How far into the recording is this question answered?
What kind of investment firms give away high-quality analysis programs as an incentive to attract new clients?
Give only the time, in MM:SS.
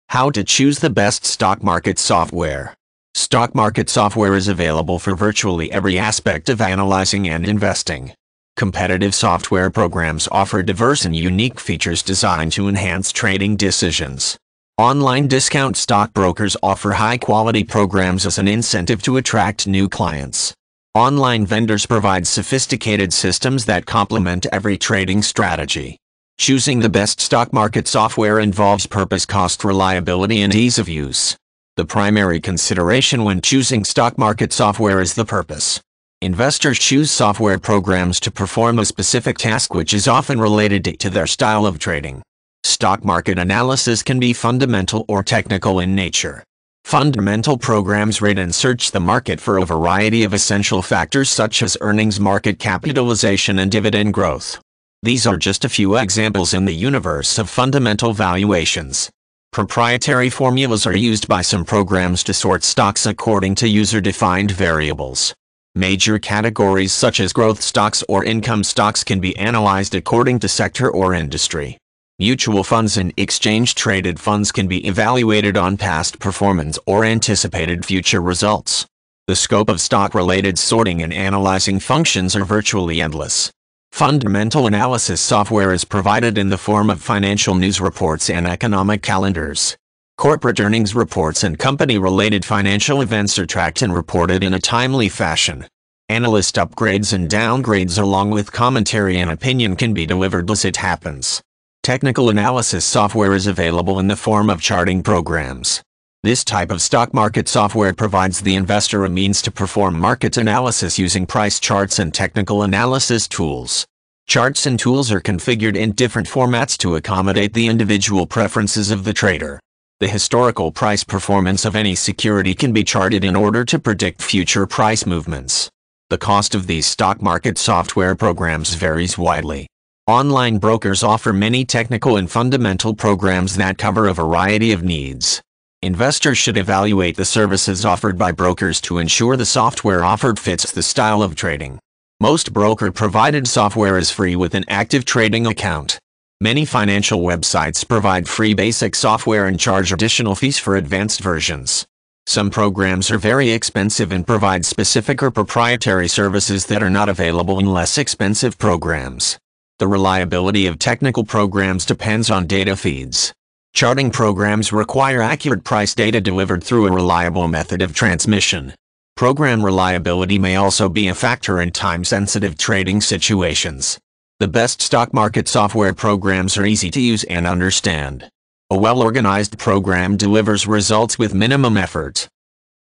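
00:14.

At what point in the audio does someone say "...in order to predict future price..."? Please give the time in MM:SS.
02:03.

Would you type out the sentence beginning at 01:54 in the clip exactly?
Charts and tools are configured in different formats to accommodate the individual preferences of the trader.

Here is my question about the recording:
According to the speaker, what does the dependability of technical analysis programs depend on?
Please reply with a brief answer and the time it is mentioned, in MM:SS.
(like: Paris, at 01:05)
data feeds, at 02:42.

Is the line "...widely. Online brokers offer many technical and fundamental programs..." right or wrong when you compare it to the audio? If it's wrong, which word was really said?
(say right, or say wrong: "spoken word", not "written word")
right.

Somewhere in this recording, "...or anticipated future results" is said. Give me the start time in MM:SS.
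01:16.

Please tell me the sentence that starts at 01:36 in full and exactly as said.
Analyst upgrades and downgrades along with commentary and opinion can be delivered as it happens.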